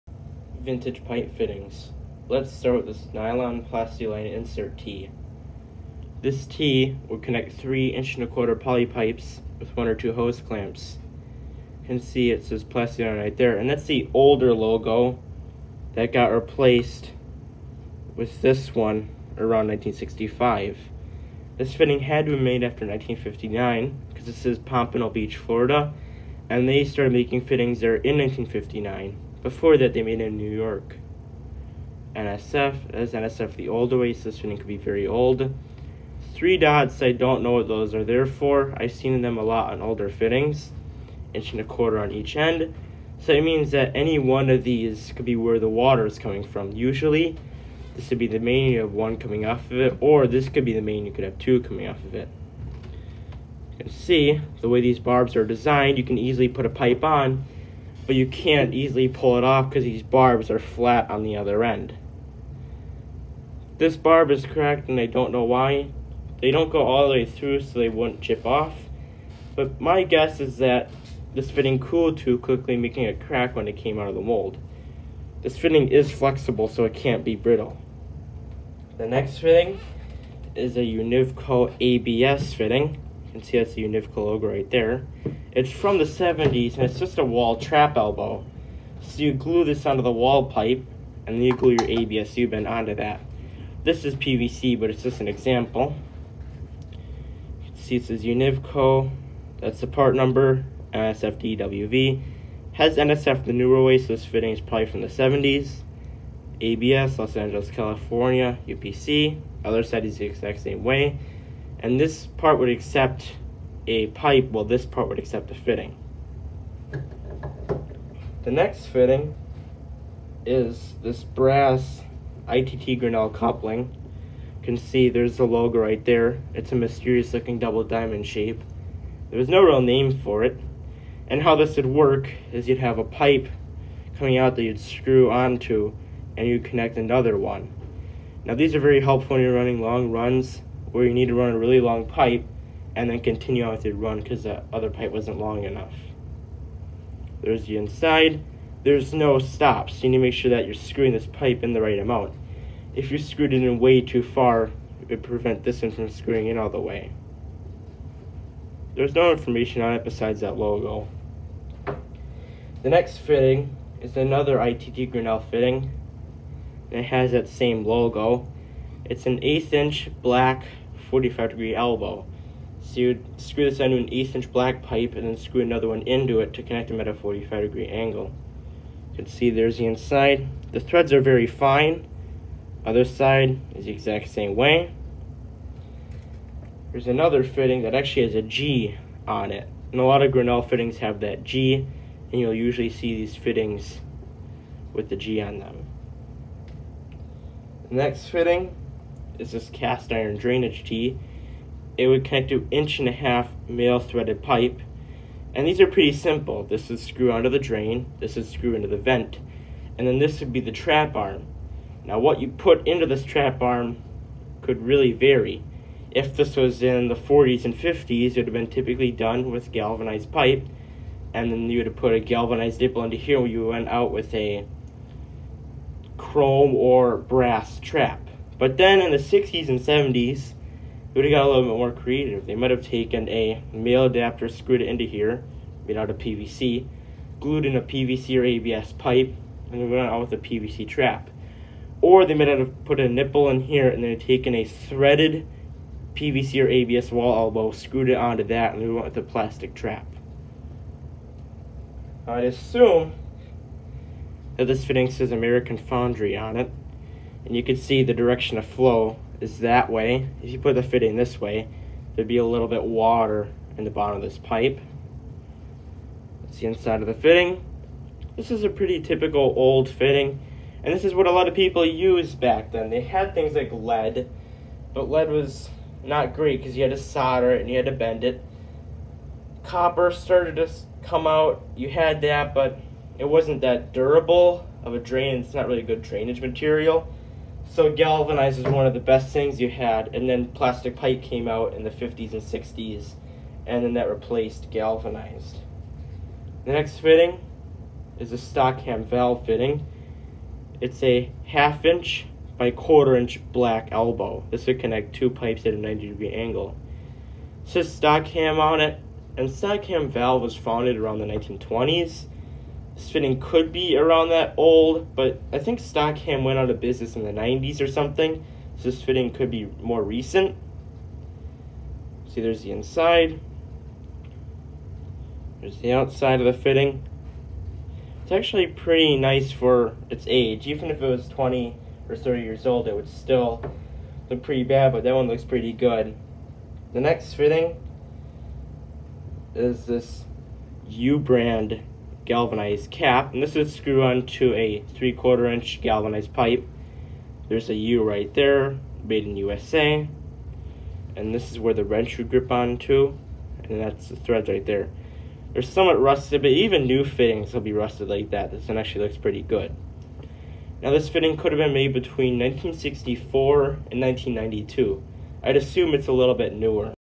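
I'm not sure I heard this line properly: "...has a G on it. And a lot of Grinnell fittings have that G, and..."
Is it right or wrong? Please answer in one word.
right.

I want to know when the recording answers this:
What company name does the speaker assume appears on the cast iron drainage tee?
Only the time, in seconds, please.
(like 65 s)
255 s.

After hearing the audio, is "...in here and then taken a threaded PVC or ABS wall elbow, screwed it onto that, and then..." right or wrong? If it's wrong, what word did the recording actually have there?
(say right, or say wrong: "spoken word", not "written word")
right.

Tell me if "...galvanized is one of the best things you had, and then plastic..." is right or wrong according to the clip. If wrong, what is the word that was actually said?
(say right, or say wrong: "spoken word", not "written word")
right.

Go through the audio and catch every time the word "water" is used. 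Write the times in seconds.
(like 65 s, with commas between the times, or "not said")
45 s, 262 s.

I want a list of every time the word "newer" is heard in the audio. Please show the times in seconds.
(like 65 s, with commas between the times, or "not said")
103 s, 366 s.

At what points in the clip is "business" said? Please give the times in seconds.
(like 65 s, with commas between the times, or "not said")
316 s.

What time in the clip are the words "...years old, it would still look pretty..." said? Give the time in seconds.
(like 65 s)
332 s.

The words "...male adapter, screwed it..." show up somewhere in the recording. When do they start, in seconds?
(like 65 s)
233 s.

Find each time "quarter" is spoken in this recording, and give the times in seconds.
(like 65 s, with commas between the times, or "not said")
8 s, 41 s, 302 s, 345 s.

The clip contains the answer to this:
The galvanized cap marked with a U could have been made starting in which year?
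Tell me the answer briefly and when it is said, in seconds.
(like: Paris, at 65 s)
1964, at 362 s.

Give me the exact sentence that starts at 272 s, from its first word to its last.
They had things like lead, but lead was not great because you had to solder it and you had to bend it.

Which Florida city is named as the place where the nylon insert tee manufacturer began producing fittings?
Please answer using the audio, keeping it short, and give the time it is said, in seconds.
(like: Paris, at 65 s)
Pompano Beach, at 24 s.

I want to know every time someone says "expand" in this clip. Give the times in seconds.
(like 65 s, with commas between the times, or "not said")
not said.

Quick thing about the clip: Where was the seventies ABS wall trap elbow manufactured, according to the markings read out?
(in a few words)
Los Angeles, California.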